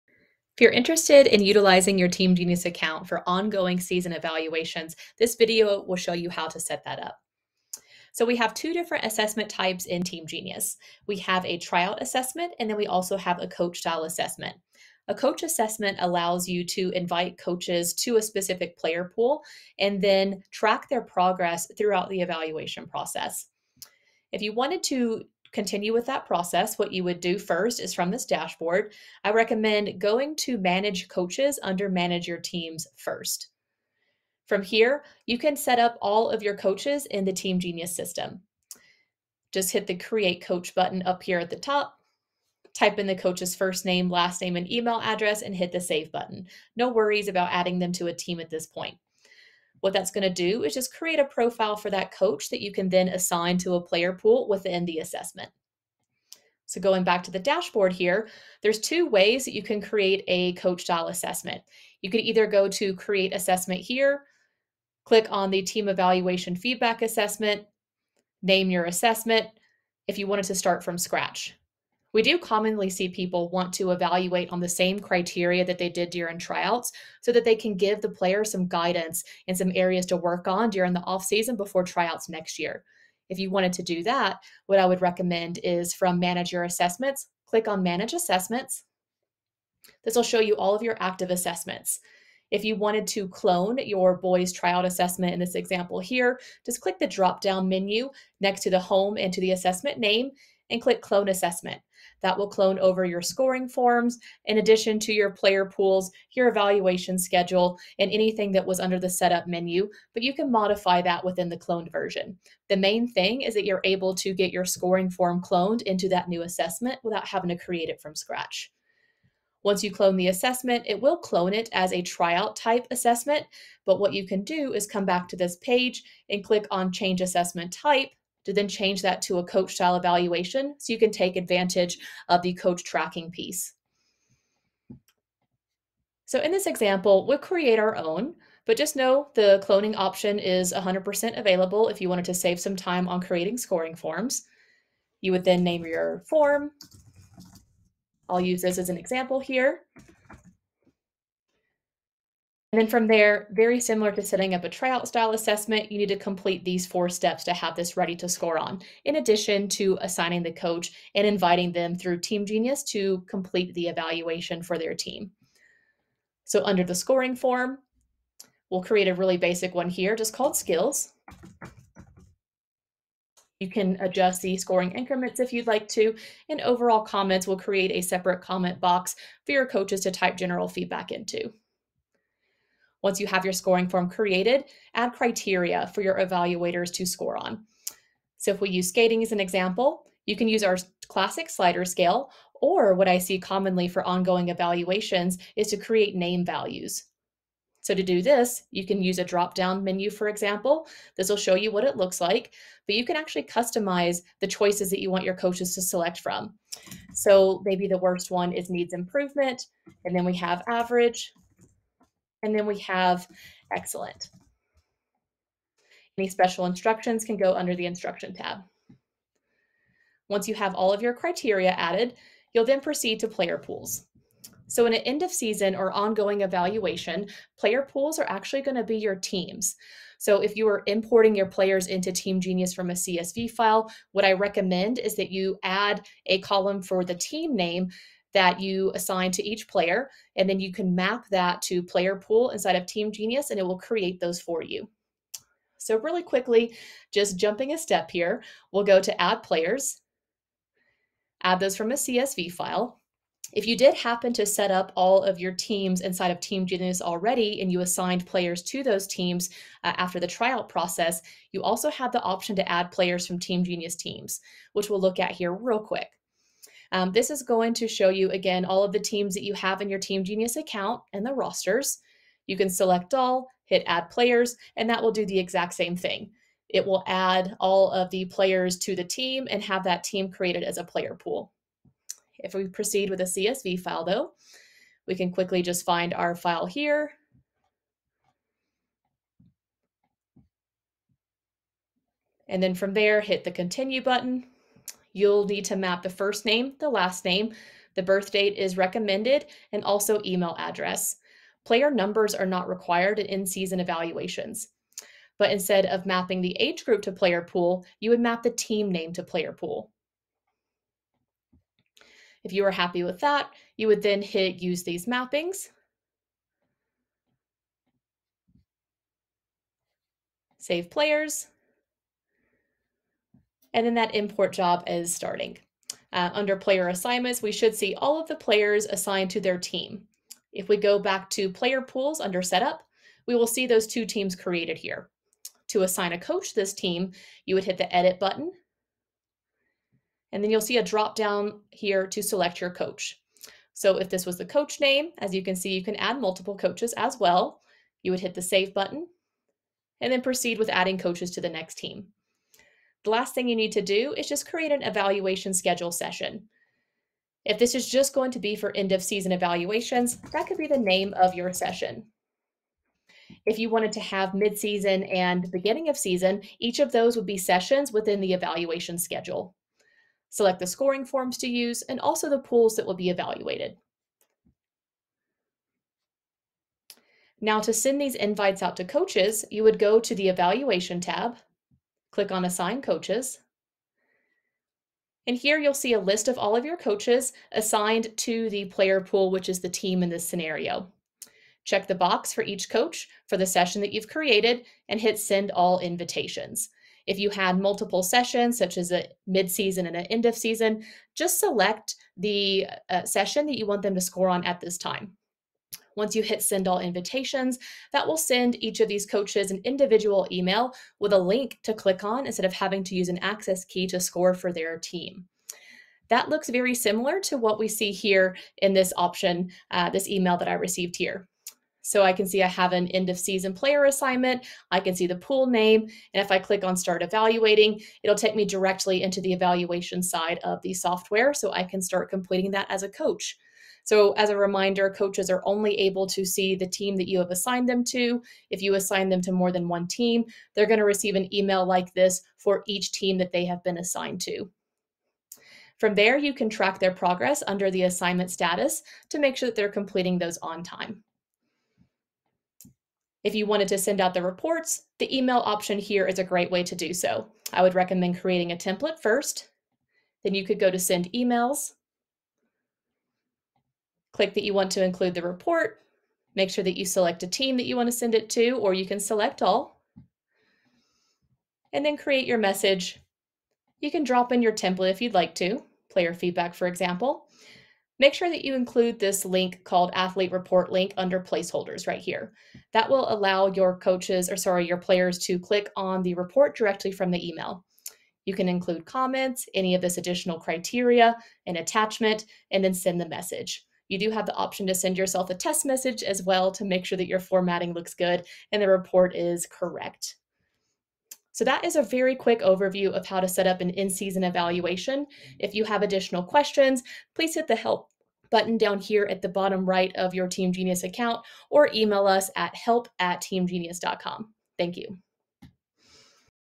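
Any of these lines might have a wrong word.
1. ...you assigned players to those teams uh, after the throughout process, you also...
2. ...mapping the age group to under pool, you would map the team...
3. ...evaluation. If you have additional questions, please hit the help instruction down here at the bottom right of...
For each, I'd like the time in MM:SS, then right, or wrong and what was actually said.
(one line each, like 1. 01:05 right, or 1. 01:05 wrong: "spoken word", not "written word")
1. 04:17 wrong: "tryout", not "throughout"
2. 05:06 wrong: "player", not "under"
3. 08:24 wrong: "button", not "instruction".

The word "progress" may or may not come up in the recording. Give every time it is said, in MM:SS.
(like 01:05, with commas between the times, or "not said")
00:21, 07:26.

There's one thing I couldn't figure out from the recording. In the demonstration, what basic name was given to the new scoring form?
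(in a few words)
skills.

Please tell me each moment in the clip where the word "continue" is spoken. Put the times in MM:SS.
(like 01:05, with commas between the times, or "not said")
00:25, 04:53.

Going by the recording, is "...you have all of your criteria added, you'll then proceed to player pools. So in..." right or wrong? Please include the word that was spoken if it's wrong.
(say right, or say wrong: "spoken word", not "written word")
right.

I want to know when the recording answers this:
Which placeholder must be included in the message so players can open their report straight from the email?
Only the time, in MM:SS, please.
07:59.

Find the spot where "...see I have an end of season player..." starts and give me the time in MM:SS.
07:02.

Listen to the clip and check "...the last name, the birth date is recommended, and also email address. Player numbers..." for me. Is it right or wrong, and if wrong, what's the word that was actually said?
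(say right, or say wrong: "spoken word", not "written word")
right.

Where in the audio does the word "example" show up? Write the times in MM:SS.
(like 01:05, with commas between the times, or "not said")
01:35, 02:16, 02:28, 03:09, 03:20, 07:56.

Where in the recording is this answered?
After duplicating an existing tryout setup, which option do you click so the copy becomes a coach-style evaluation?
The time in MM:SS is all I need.
02:06.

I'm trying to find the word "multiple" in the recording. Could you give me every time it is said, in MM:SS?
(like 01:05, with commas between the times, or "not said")
05:46, 06:37.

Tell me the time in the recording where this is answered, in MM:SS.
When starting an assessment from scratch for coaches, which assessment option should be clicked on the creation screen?
01:05.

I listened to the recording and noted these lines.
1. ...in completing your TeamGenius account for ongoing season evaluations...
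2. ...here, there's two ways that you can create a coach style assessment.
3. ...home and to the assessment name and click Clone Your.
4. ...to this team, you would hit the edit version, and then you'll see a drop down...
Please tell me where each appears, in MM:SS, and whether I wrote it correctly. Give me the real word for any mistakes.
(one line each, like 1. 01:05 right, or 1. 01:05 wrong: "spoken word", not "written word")
1. 00:01 wrong: "utilizing", not "completing"
2. 00:57 right
3. 01:38 wrong: "Assessment", not "Your"
4. 05:36 wrong: "button", not "version".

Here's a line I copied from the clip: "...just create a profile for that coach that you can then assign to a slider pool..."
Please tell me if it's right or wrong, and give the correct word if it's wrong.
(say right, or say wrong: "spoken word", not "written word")
wrong: "player", not "slider".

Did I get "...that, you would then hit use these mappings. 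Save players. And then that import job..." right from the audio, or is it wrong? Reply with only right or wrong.
right.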